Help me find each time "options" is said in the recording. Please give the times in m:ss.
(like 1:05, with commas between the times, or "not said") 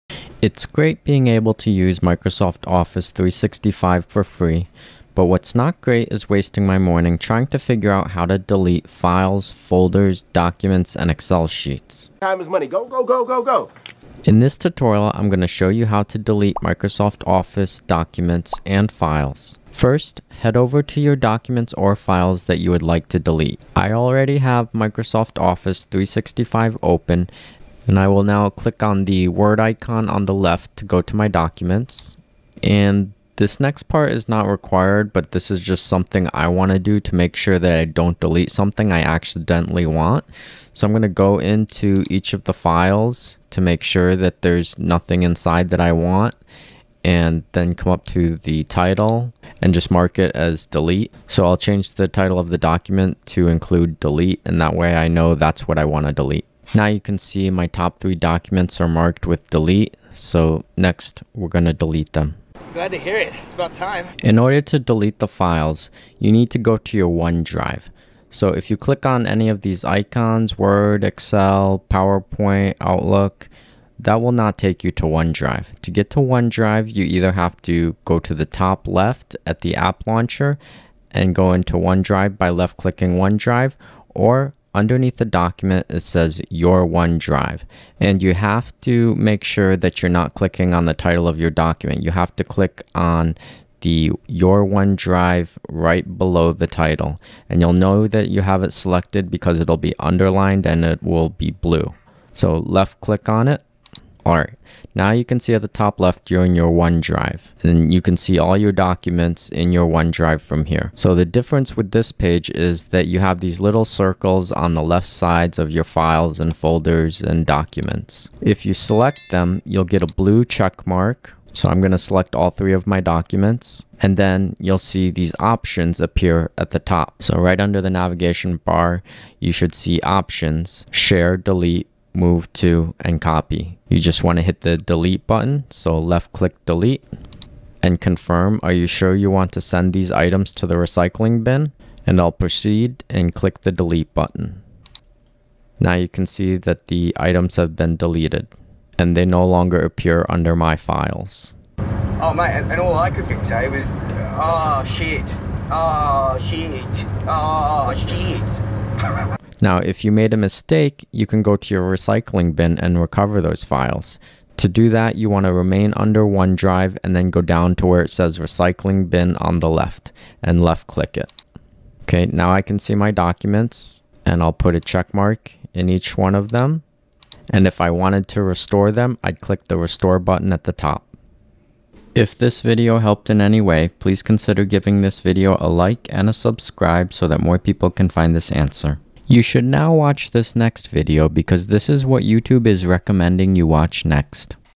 2:05, 2:10.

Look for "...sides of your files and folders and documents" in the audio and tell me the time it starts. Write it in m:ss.
1:55.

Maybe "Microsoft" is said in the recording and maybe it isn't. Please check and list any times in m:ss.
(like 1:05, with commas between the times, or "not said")
0:01, 0:16, 0:24.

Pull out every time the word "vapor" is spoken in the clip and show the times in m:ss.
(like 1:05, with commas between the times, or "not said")
not said.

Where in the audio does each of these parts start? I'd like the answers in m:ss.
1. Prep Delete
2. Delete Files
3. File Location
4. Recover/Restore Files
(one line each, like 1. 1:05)
1. 0:35
2. 1:48
3. 1:05
4. 2:40.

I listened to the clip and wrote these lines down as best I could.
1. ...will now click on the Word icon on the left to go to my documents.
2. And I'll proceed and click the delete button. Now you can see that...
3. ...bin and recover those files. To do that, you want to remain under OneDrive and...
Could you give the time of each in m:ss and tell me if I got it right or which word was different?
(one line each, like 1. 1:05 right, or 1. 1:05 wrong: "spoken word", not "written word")
1. 0:28 right
2. 2:22 right
3. 2:42 right.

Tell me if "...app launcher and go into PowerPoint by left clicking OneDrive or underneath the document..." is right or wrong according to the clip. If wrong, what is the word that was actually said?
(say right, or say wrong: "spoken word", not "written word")
wrong: "OneDrive", not "PowerPoint".